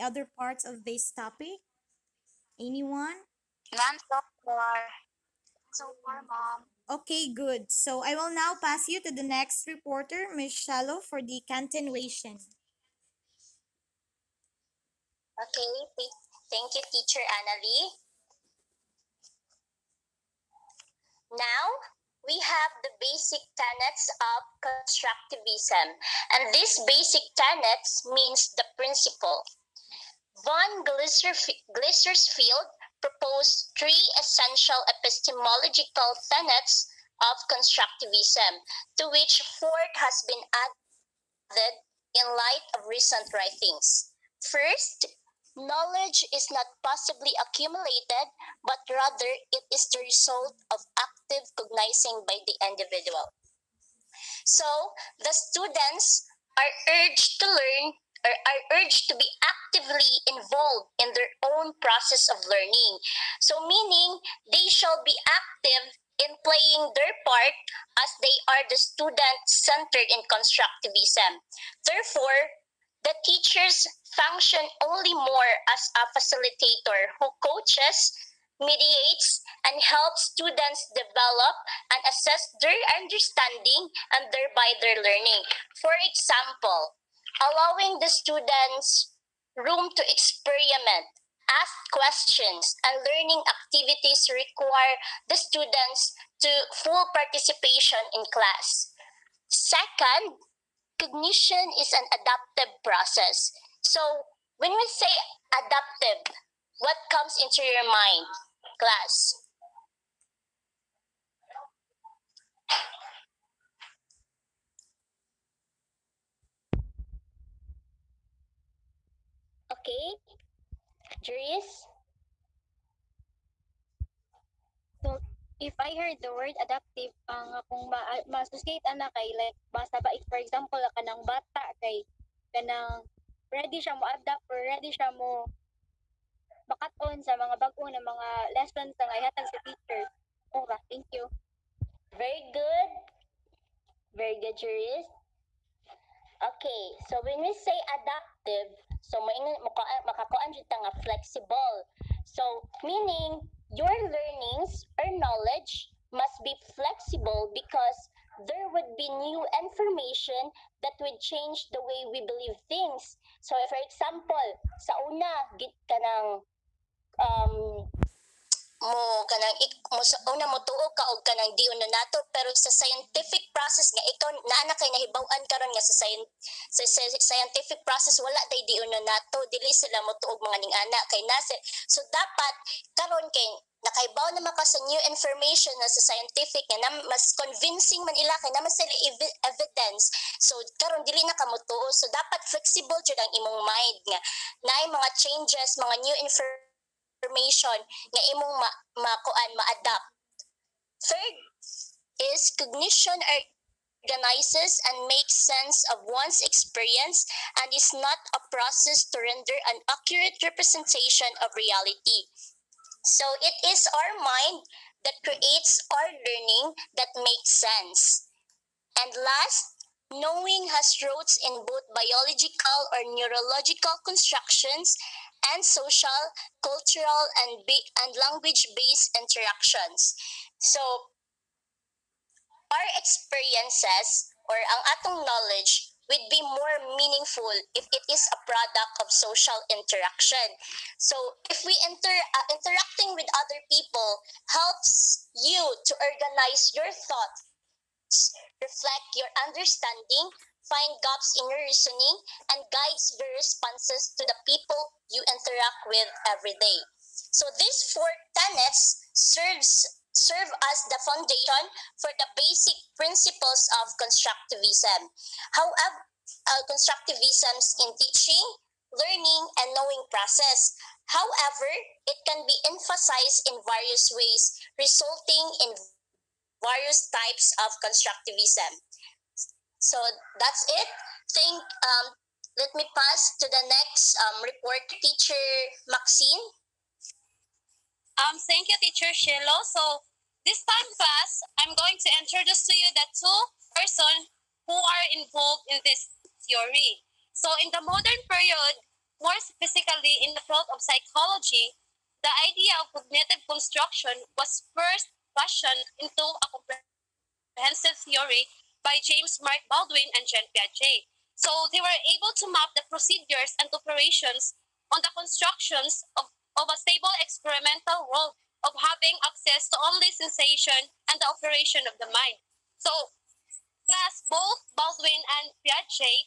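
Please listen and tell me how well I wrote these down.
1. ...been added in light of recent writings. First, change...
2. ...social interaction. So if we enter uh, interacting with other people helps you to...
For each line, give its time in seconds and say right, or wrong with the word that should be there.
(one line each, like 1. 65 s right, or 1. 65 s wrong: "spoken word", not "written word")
1. 40 s wrong: "knowledge", not "change"
2. 239 s right.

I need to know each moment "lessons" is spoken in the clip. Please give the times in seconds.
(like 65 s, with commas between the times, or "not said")
138 s.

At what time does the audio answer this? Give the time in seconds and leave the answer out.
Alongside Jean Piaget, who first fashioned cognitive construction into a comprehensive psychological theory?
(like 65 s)
308 s.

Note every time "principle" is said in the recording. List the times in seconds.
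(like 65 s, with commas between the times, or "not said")
28 s, 262 s.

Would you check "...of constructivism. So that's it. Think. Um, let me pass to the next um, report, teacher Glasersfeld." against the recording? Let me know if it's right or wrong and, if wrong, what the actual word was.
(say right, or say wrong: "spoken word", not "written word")
wrong: "Maxine", not "Glasersfeld".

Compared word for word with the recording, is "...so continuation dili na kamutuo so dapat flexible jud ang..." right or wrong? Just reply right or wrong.
wrong.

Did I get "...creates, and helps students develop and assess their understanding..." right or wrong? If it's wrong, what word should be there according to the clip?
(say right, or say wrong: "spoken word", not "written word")
wrong: "mediates", not "creates".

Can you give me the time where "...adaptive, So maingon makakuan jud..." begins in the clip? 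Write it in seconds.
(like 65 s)
147 s.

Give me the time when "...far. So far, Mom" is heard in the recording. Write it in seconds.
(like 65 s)
4 s.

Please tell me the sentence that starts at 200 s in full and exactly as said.
Third is cognition organizes and makes sense of one's experience and is not a process to render an accurate representation of reality.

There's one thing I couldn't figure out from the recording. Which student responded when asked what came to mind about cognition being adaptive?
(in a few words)
Jurist.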